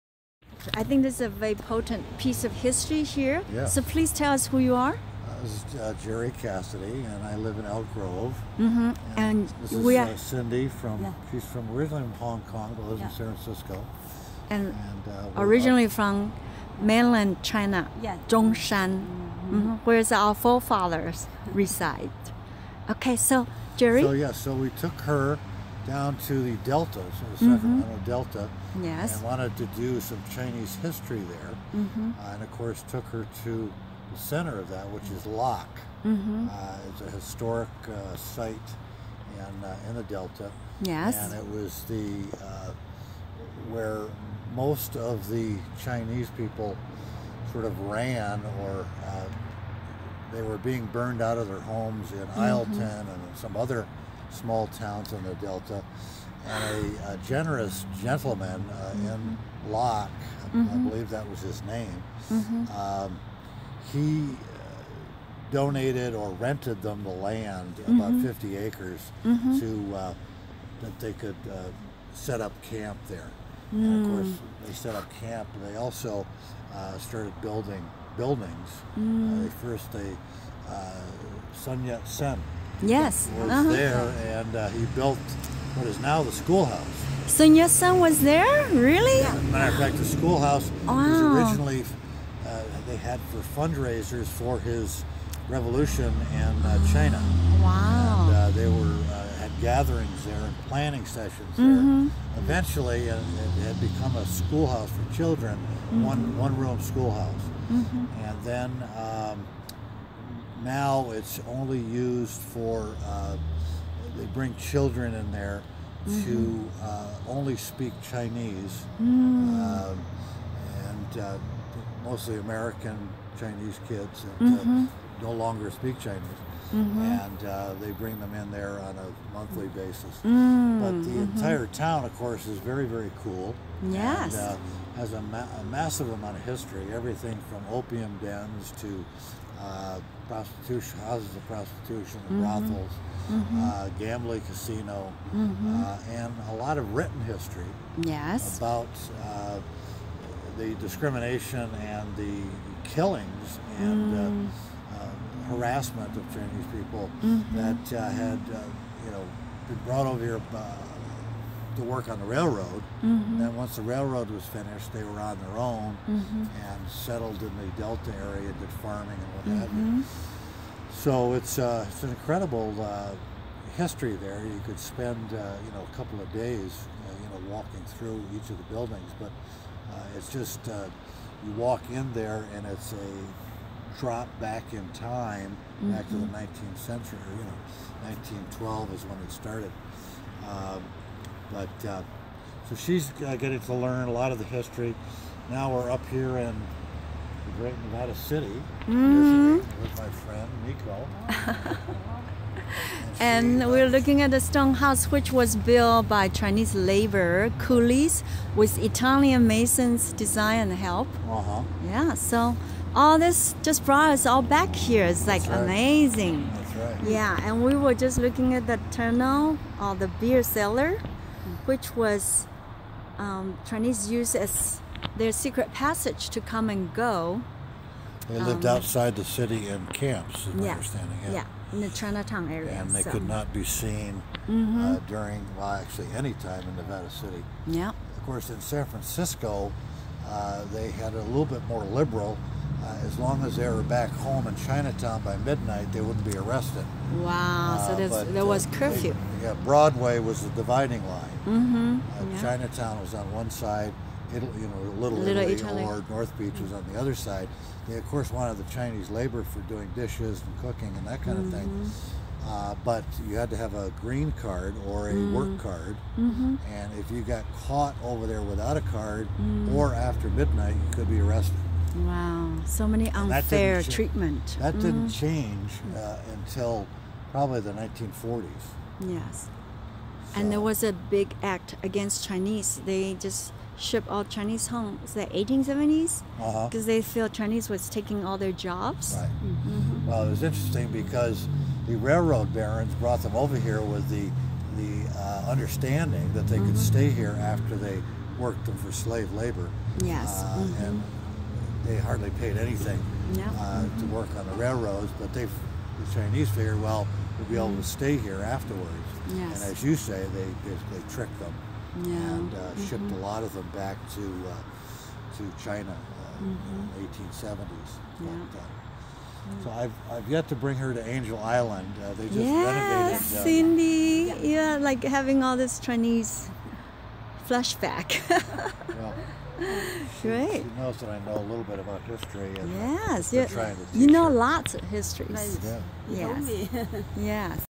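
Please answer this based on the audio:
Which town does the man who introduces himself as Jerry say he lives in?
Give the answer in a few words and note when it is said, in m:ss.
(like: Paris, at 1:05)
Elk Grove, at 0:07.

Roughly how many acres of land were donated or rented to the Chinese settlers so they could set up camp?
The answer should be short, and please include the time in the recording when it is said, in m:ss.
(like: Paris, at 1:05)
50 acres, at 1:08.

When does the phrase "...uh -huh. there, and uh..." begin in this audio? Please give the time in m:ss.
1:23.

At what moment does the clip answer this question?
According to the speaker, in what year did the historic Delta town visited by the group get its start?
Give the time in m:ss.
3:08.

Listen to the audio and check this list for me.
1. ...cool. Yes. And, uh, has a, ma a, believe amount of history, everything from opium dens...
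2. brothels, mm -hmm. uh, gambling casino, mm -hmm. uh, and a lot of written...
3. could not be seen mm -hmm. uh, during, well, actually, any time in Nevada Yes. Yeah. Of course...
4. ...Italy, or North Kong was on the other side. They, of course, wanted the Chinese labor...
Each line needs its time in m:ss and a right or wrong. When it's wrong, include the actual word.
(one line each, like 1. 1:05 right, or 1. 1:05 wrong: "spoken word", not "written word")
1. 2:13 wrong: "massive", not "believe"
2. 2:22 right
3. 3:53 wrong: "City", not "Yes"
4. 4:15 wrong: "Beach", not "Kong".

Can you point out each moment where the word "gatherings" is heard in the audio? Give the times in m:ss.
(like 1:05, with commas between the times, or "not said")
1:39.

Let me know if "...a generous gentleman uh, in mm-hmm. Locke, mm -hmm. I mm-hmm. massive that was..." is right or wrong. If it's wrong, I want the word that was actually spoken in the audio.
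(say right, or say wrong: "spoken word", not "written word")
wrong: "believe", not "massive".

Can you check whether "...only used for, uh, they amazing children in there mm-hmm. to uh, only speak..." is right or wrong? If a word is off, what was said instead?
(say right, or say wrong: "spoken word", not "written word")
wrong: "bring", not "amazing".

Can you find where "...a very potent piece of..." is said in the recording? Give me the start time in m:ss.
0:01.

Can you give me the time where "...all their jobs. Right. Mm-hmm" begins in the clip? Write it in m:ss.
4:48.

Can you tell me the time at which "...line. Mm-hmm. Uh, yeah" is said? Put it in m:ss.
4:11.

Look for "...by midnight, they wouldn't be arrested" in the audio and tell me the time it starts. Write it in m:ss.
4:05.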